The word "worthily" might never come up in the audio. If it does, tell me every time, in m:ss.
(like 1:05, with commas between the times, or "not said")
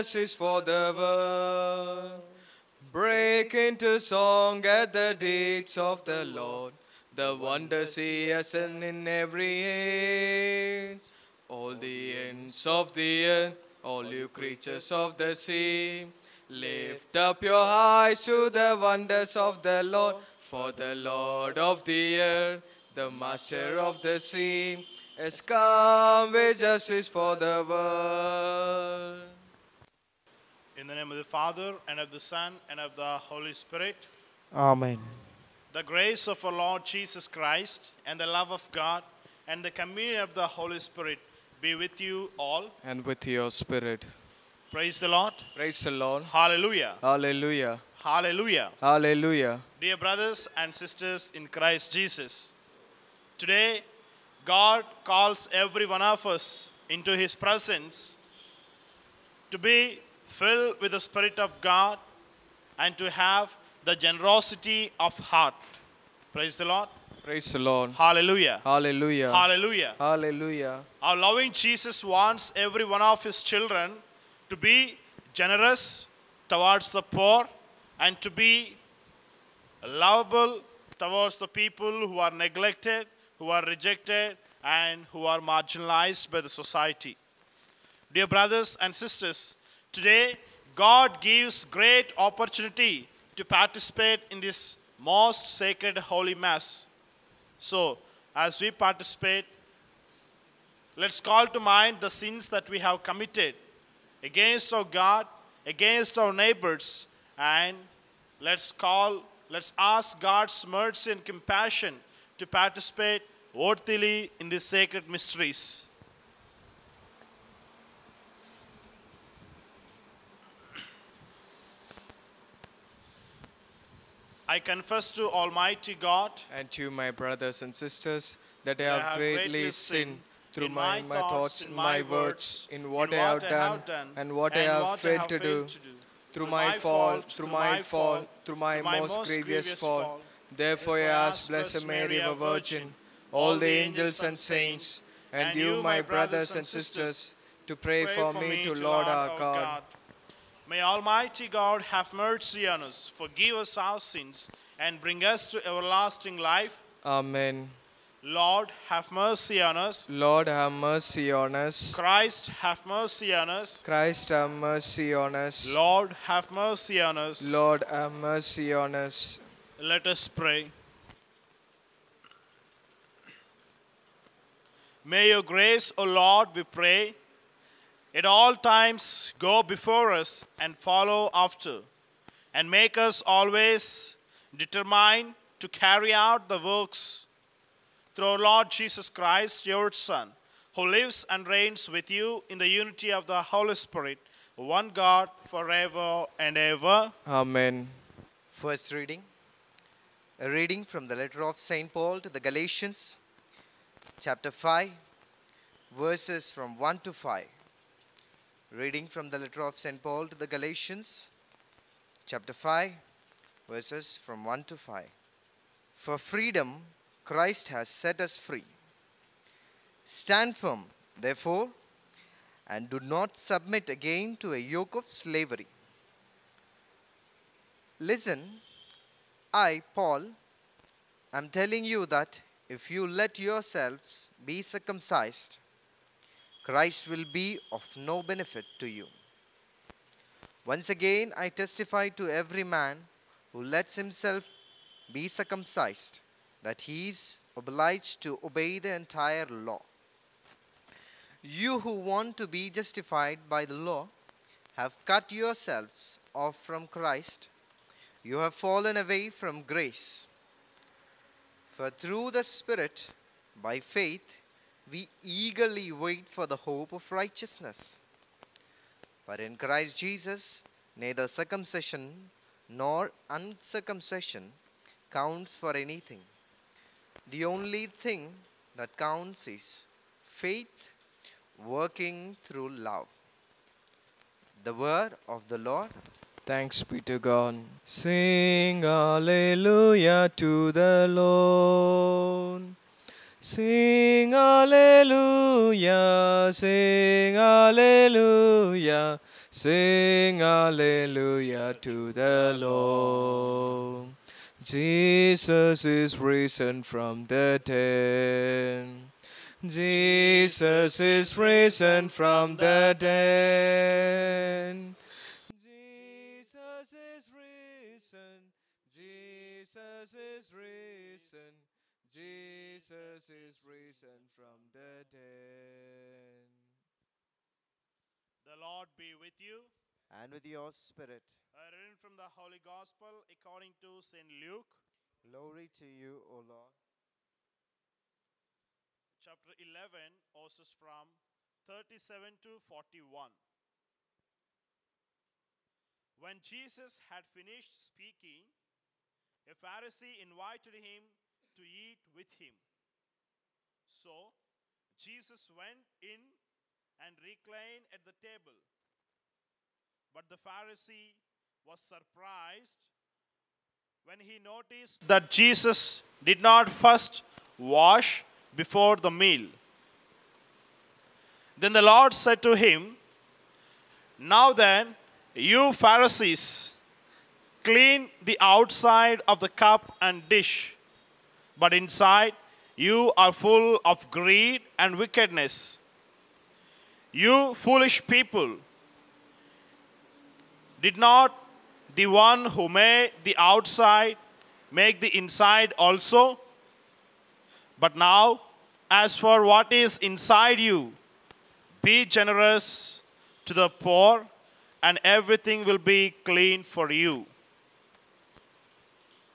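1:53.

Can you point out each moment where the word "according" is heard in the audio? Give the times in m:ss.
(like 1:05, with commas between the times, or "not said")
5:33.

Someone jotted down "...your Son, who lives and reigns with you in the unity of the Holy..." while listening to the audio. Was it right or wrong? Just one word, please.
right.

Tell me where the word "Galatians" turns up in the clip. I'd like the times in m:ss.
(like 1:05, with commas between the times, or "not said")
3:22, 3:30.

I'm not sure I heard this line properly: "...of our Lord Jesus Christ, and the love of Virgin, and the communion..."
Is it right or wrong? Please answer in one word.
wrong.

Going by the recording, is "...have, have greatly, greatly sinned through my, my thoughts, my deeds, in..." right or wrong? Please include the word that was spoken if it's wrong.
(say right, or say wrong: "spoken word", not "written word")
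wrong: "words", not "deeds".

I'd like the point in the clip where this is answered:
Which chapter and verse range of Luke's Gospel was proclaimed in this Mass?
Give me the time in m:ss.
5:39.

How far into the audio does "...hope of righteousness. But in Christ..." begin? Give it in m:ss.
4:26.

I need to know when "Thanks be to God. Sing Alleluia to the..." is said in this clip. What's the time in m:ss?
4:46.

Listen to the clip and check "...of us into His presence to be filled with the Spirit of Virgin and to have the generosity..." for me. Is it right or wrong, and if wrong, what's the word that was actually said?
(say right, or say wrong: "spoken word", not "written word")
wrong: "God", not "Virgin".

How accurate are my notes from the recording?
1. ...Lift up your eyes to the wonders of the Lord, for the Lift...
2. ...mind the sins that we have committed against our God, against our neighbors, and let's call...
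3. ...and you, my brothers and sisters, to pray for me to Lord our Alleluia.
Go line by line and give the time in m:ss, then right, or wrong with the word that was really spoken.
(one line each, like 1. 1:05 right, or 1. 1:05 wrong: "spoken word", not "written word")
1. 0:16 wrong: "Lord", not "Lift"
2. 1:41 right
3. 2:25 wrong: "God", not "Alleluia".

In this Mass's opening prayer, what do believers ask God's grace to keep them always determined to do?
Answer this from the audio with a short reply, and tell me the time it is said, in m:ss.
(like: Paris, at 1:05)
carry out the works, at 3:05.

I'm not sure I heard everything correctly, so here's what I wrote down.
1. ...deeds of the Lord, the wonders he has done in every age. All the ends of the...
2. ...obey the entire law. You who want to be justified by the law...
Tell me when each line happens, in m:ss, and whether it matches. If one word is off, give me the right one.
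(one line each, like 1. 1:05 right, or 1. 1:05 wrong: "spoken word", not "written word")
1. 0:05 right
2. 4:08 right.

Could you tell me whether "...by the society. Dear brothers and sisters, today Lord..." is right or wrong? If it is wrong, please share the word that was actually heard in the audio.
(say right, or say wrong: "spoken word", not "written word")
wrong: "God", not "Lord".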